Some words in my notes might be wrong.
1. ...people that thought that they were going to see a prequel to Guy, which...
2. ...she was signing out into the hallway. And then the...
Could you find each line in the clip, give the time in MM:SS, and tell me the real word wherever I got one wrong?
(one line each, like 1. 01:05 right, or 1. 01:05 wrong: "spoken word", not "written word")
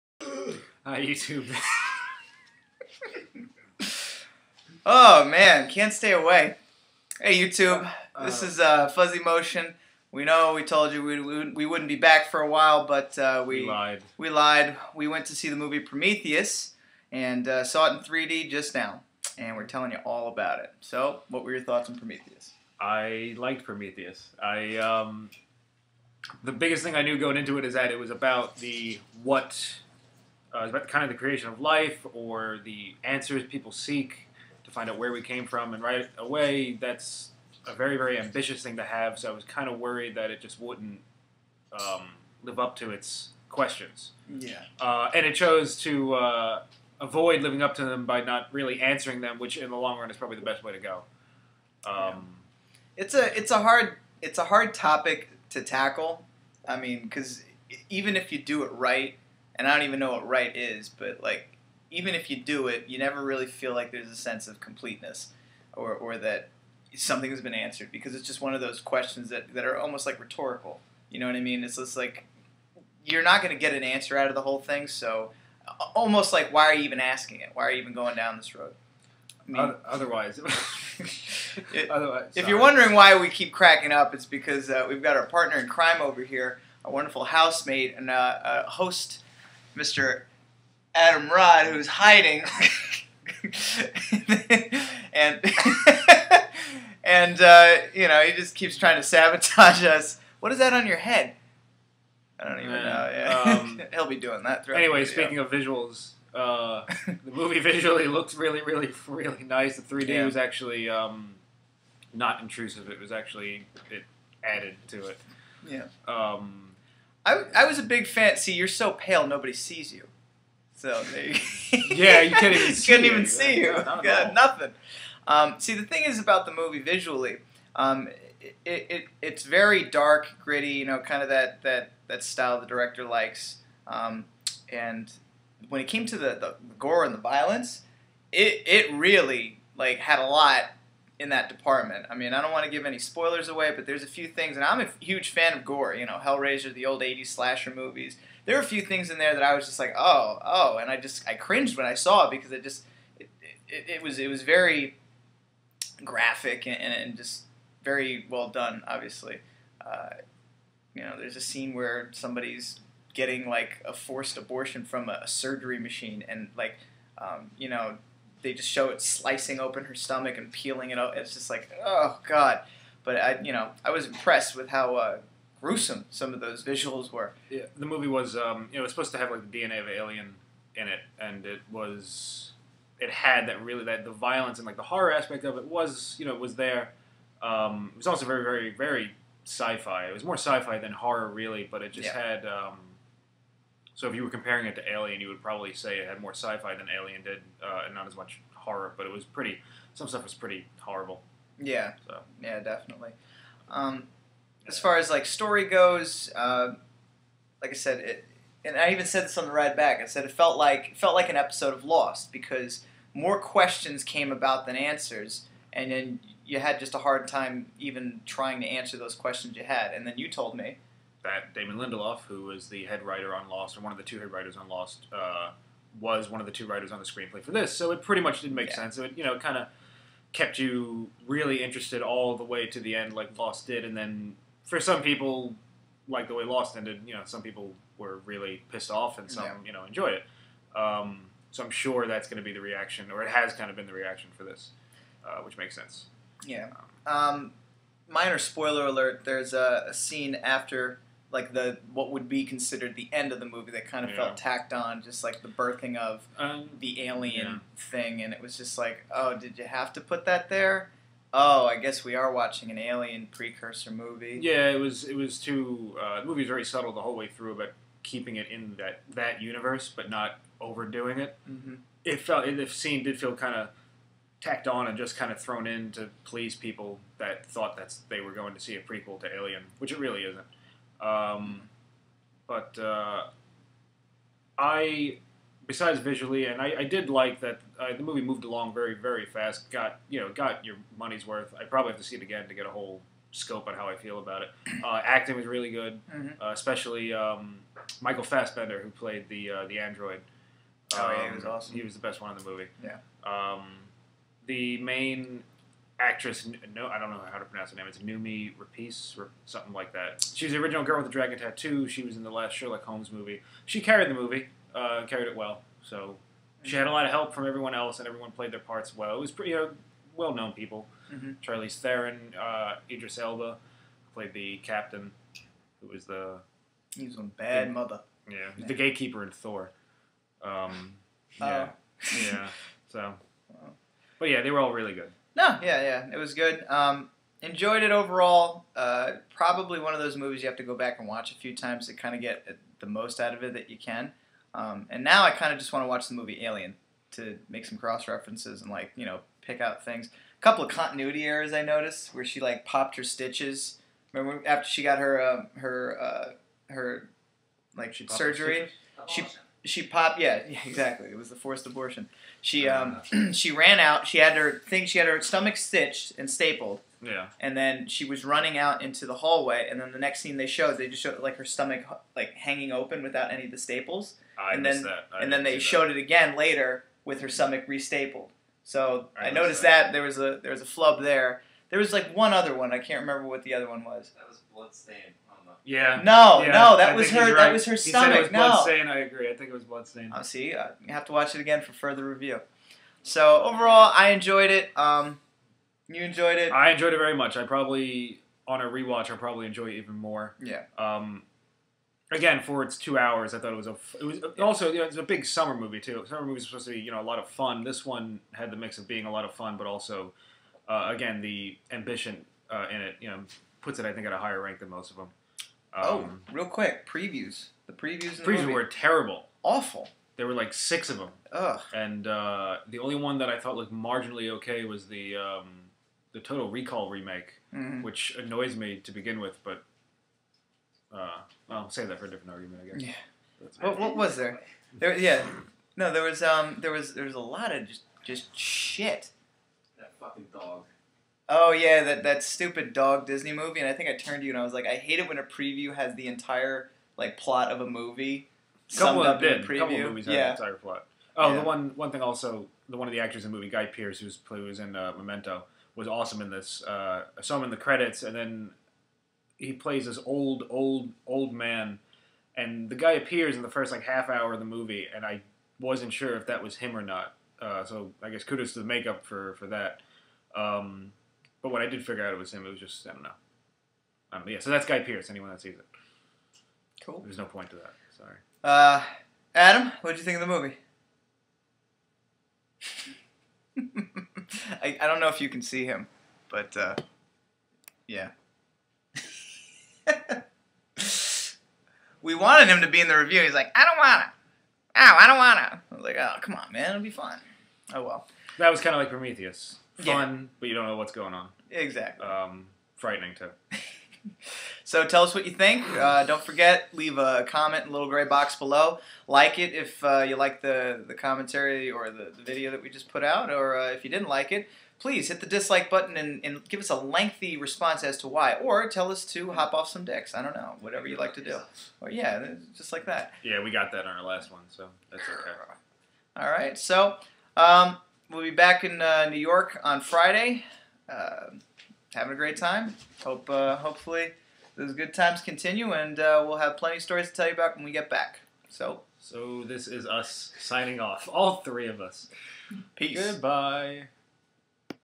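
1. 04:36 wrong: "Alien", not "Guy"
2. 06:07 wrong: "running", not "signing".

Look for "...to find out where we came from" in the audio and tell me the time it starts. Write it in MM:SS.
00:34.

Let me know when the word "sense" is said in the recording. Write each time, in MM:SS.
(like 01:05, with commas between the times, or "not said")
01:04, 03:48, 04:05.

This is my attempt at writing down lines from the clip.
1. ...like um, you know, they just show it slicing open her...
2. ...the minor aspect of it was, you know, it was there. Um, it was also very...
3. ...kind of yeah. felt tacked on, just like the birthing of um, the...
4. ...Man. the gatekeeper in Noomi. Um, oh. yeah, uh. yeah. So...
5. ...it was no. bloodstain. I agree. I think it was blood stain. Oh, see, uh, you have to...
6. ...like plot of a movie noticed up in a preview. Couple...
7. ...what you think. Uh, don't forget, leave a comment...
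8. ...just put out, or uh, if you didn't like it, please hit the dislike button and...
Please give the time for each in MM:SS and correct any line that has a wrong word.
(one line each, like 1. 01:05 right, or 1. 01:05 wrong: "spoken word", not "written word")
1. 02:46 right
2. 03:04 wrong: "horror", not "minor"
3. 04:13 right
4. 05:28 wrong: "Thor", not "Noomi"
5. 06:28 right
6. 07:26 wrong: "summed", not "noticed"
7. 08:25 right
8. 08:32 right.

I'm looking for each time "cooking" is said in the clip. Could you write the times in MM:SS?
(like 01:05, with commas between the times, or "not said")
not said.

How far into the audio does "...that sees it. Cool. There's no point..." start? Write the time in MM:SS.
07:55.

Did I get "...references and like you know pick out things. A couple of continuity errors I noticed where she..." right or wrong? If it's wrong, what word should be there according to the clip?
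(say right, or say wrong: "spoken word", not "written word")
right.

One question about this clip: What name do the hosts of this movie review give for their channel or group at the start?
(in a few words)
Fuzzymotion.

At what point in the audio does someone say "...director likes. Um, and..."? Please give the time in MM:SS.
02:12.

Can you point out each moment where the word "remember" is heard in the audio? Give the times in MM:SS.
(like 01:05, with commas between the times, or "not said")
05:54, 06:23.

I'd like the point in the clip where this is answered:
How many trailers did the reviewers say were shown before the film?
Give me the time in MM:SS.
07:00.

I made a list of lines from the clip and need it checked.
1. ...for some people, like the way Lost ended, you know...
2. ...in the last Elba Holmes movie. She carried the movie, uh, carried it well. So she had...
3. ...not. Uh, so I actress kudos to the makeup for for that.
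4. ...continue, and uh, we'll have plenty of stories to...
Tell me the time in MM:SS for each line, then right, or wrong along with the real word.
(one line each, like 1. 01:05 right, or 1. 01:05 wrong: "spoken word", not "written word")
1. 03:54 right
2. 05:12 wrong: "Sherlock", not "Elba"
3. 07:46 wrong: "guess", not "actress"
4. 08:55 right.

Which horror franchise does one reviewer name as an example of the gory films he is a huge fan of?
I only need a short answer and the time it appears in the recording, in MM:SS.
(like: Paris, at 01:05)
Hellraiser, at 02:26.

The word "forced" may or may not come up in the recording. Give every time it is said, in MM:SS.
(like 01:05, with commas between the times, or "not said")
02:43, 06:01.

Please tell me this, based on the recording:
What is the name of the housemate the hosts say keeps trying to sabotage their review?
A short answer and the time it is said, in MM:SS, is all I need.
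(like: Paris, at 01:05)
Adam Rod, at 01:30.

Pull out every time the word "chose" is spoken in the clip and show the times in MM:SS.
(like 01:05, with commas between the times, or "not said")
00:45.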